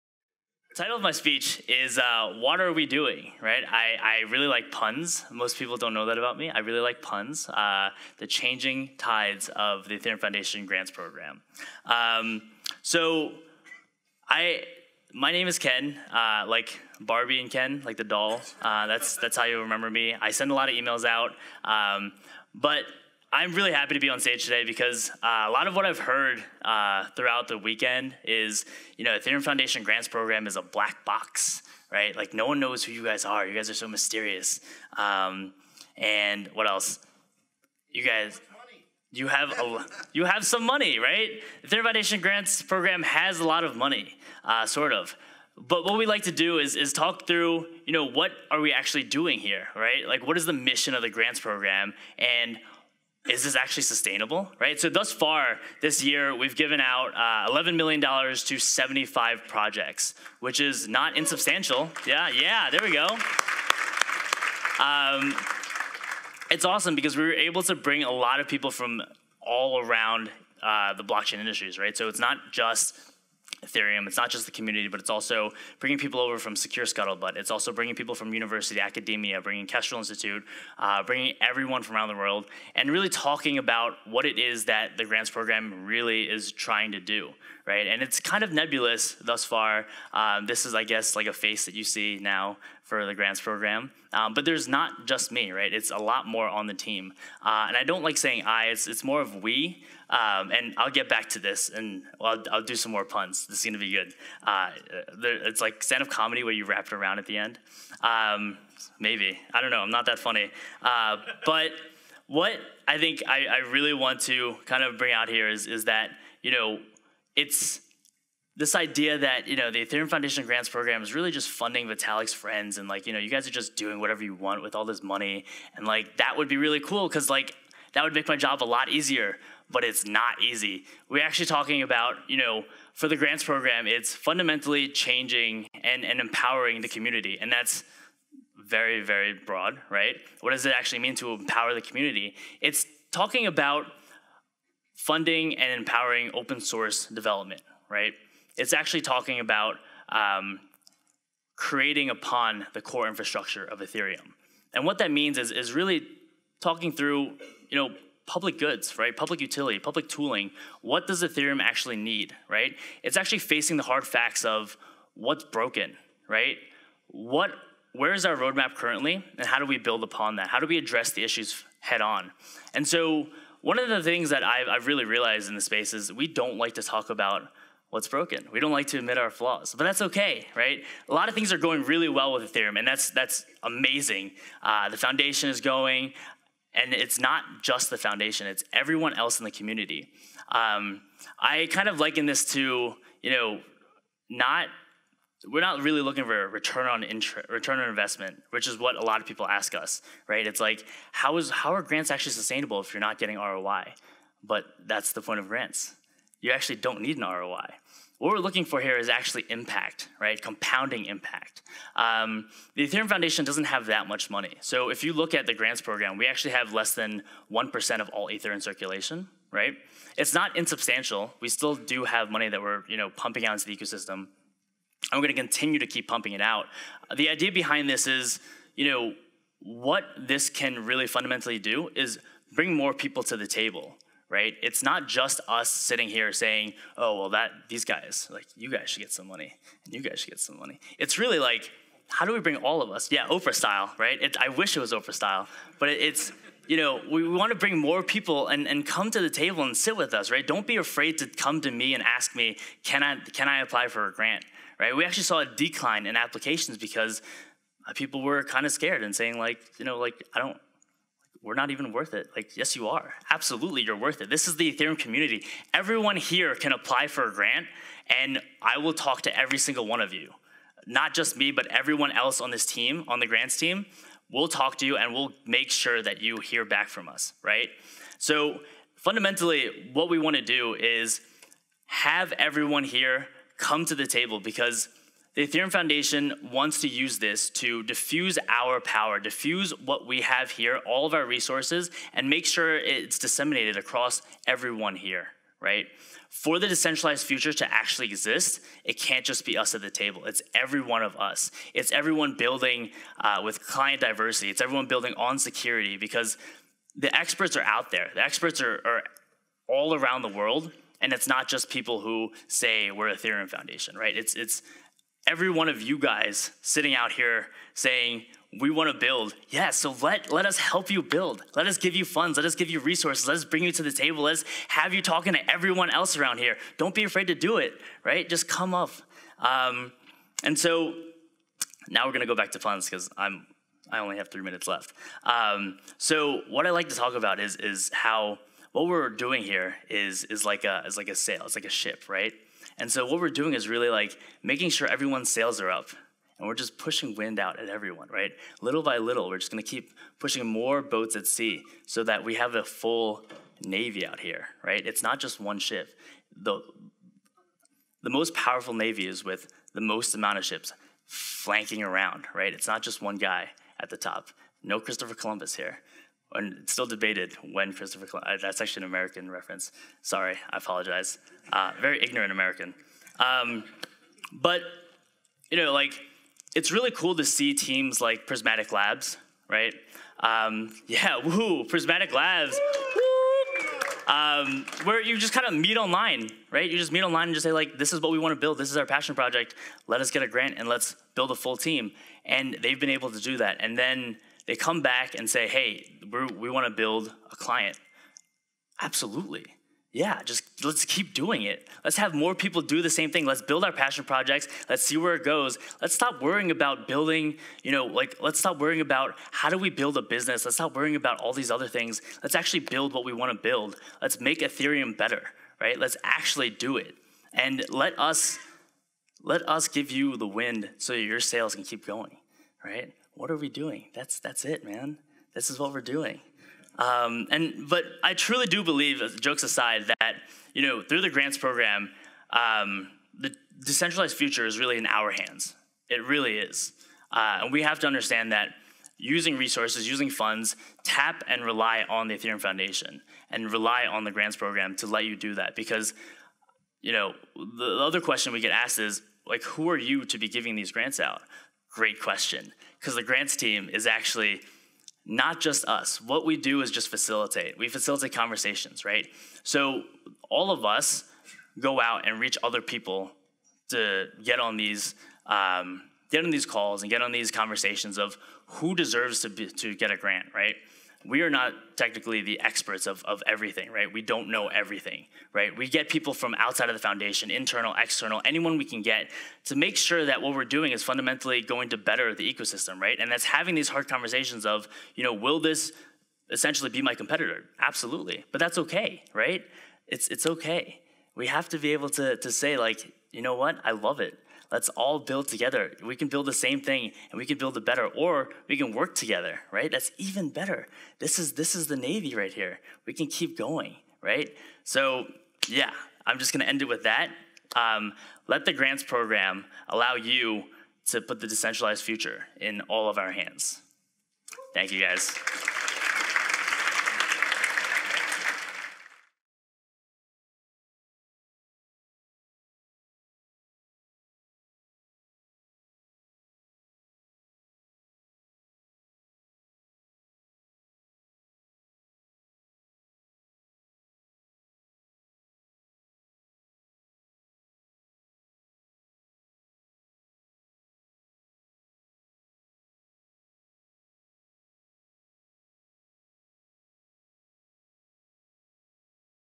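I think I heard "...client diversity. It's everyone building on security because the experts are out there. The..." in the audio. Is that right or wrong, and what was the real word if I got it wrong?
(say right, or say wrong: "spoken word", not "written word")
right.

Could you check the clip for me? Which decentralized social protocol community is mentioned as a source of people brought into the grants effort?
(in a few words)
Secure Scuttlebutt.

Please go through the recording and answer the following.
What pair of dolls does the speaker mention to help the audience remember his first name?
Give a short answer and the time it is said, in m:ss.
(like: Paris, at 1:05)
Barbie and Ken, at 0:16.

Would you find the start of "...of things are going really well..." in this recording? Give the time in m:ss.
3:01.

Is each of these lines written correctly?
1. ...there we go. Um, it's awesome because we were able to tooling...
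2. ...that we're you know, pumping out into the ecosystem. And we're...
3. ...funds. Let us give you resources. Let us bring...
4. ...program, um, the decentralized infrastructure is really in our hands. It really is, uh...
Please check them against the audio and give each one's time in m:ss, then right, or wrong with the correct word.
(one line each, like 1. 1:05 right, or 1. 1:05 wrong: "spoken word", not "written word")
1. 1:02 wrong: "bring", not "tooling"
2. 3:42 right
3. 5:22 right
4. 7:11 wrong: "future", not "infrastructure".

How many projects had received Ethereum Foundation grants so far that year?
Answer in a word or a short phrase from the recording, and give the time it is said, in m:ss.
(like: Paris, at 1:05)
75, at 0:58.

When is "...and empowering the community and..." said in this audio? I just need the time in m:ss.
2:16.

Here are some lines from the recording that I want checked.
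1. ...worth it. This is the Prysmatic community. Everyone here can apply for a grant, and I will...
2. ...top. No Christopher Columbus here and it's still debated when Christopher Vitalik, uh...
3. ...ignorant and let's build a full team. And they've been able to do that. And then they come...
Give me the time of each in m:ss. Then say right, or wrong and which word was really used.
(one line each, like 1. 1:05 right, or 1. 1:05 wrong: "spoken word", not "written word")
1. 4:23 wrong: "Ethereum", not "Prysmatic"
2. 6:03 wrong: "Columbus", not "Vitalik"
3. 6:30 wrong: "grant", not "ignorant".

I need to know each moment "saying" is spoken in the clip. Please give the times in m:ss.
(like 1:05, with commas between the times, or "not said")
1:38, 3:56, 4:19, 5:17.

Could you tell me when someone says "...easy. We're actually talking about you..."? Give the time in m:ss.
2:10.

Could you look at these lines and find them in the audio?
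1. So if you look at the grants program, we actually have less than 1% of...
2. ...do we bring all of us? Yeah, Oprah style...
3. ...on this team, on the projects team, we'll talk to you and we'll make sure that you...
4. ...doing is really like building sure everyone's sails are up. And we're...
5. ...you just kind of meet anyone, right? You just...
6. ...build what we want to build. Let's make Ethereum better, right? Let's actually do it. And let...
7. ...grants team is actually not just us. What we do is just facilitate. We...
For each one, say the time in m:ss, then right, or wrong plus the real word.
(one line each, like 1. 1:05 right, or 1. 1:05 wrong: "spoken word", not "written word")
1. 3:34 right
2. 4:02 right
3. 4:32 wrong: "grants", not "projects"
4. 5:43 wrong: "making", not "building"
5. 6:25 wrong: "online", not "anyone"
6. 6:52 right
7. 7:33 right.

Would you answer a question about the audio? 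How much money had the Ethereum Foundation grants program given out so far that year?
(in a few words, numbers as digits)
$11 million.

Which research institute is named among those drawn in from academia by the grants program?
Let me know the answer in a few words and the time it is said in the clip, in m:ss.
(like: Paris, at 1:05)
Kestrel Institute, at 1:19.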